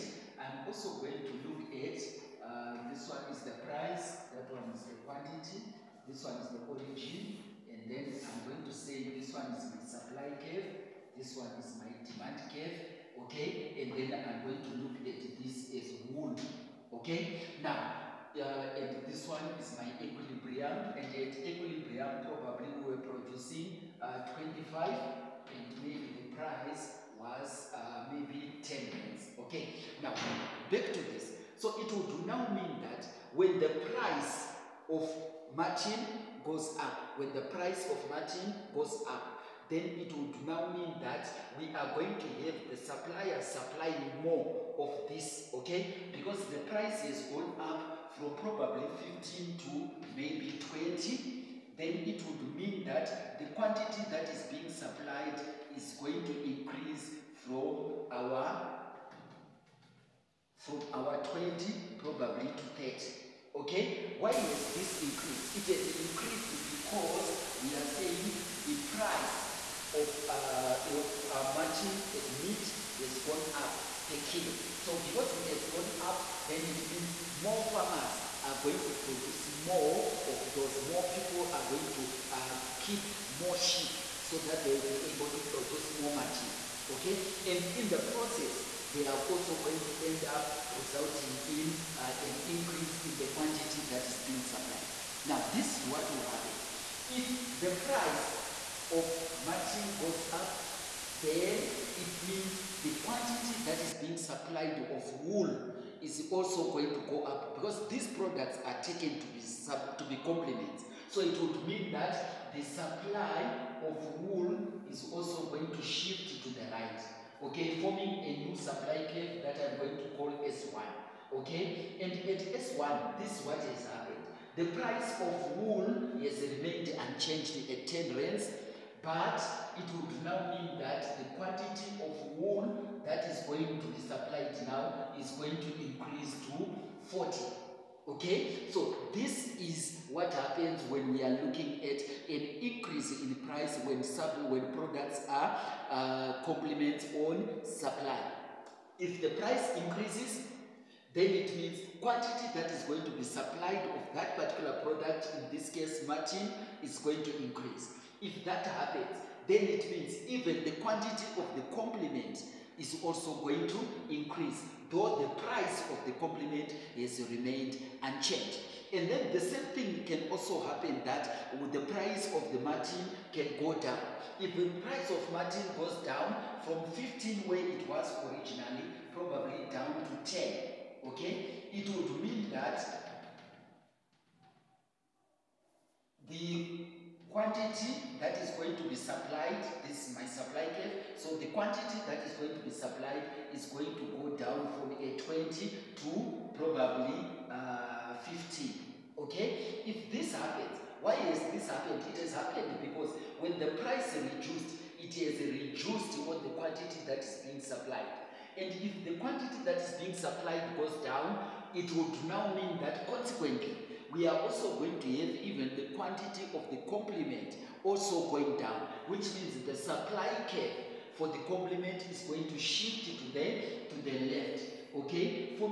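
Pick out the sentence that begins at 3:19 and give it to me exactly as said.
If this happens, why has this happened?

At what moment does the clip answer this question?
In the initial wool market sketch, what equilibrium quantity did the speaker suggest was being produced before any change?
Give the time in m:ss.
0:24.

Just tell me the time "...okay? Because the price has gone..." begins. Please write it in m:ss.
0:45.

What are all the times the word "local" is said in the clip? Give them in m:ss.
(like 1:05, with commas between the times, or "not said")
not said.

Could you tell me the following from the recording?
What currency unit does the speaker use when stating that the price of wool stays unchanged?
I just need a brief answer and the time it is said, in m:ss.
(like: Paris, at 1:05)
rands, at 2:08.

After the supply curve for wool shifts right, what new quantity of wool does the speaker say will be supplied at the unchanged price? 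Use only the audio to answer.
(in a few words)
40.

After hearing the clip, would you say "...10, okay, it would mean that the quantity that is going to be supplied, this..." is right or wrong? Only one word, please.
right.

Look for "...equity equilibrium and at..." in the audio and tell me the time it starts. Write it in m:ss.
0:19.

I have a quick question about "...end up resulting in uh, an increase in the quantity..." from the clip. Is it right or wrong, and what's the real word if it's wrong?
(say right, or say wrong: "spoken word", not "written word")
right.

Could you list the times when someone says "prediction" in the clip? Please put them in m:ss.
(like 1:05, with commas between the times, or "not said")
not said.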